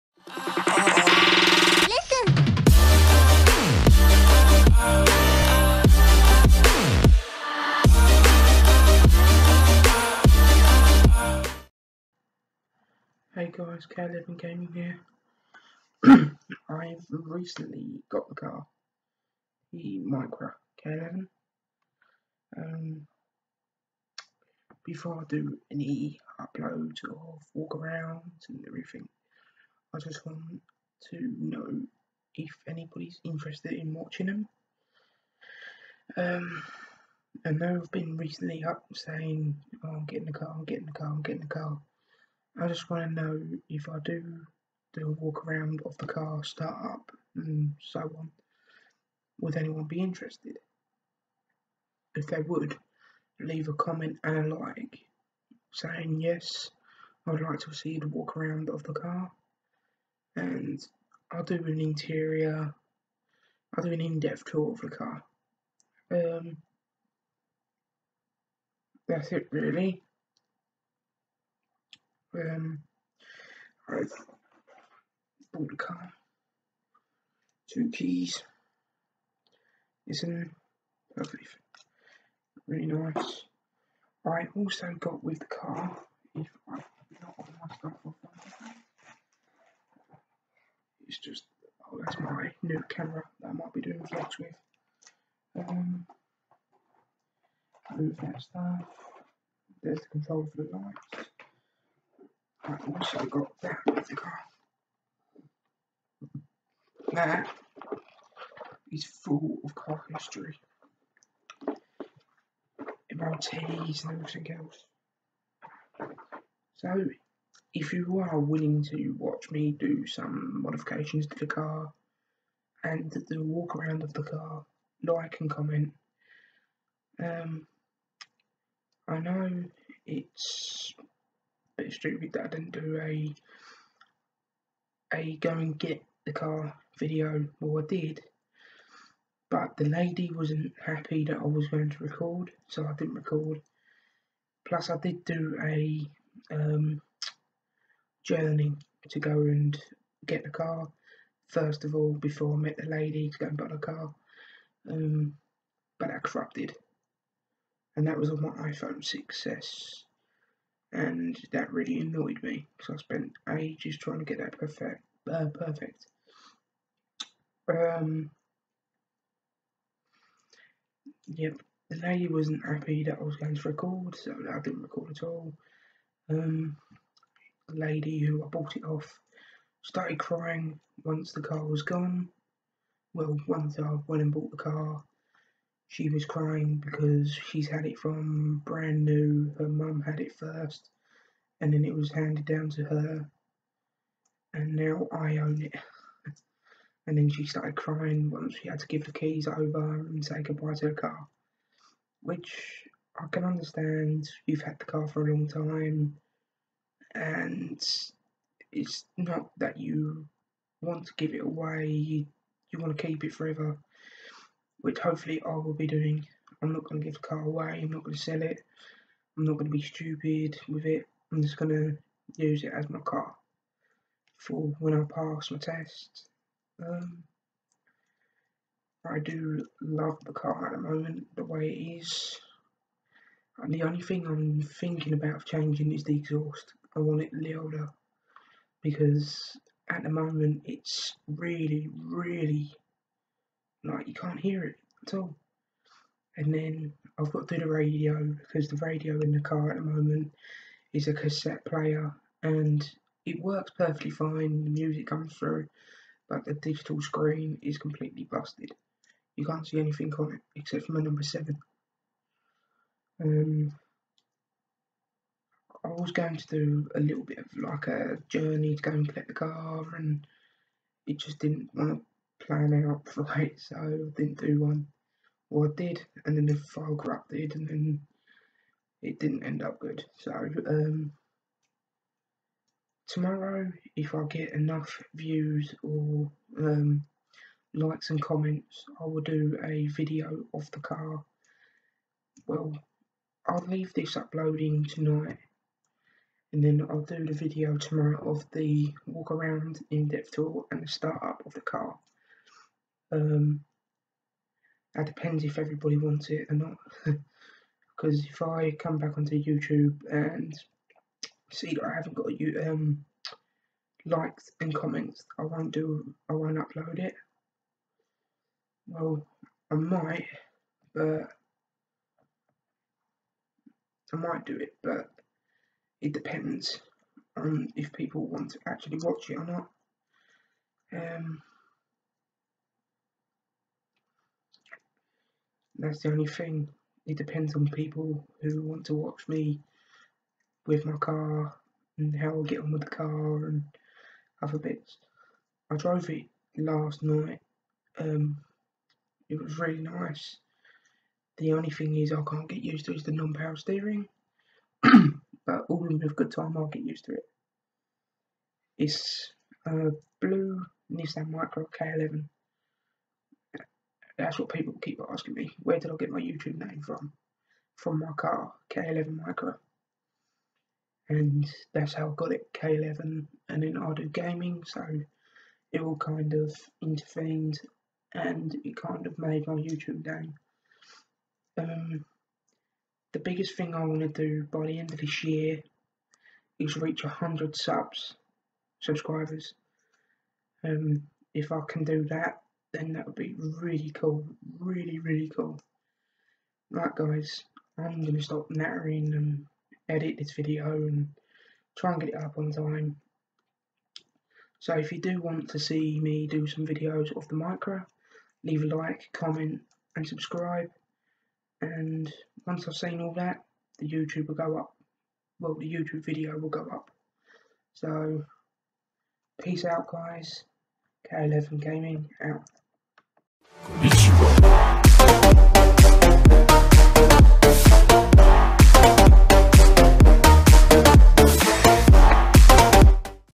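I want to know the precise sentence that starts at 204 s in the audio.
You've had the car for a long time, and it's not that you want to give it away.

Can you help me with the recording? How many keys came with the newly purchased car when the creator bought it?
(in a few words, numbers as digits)
2.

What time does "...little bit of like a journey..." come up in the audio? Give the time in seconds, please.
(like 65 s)
266 s.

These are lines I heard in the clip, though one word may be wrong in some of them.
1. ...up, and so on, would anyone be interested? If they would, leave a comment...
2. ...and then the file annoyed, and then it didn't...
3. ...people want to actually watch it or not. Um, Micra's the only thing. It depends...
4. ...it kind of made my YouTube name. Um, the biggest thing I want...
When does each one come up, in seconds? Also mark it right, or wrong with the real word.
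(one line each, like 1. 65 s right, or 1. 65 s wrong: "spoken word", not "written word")
1. 46 s right
2. 276 s wrong: "corrupted", not "annoyed"
3. 327 s wrong: "That", not "Micra"
4. 378 s right.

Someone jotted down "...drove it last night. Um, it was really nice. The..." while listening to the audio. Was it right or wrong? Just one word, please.
right.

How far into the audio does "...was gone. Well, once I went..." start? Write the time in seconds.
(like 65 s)
181 s.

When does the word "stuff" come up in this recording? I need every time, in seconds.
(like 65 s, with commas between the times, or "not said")
87 s, 98 s.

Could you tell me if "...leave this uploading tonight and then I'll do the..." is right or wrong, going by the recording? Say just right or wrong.
right.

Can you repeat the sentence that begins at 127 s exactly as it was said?
Um, I know it's bit stupid that I didn't do a a go and get the car video.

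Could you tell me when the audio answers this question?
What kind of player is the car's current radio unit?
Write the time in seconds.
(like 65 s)
251 s.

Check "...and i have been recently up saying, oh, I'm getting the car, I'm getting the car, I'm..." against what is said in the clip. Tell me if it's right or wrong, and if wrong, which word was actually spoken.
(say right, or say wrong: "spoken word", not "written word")
right.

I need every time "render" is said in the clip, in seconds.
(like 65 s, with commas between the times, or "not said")
not said.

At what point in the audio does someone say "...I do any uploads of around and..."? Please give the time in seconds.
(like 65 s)
25 s.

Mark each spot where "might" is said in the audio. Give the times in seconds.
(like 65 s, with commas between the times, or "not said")
93 s, 319 s, 324 s.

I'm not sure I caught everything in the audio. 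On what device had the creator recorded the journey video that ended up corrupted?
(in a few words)
iPhone 6s.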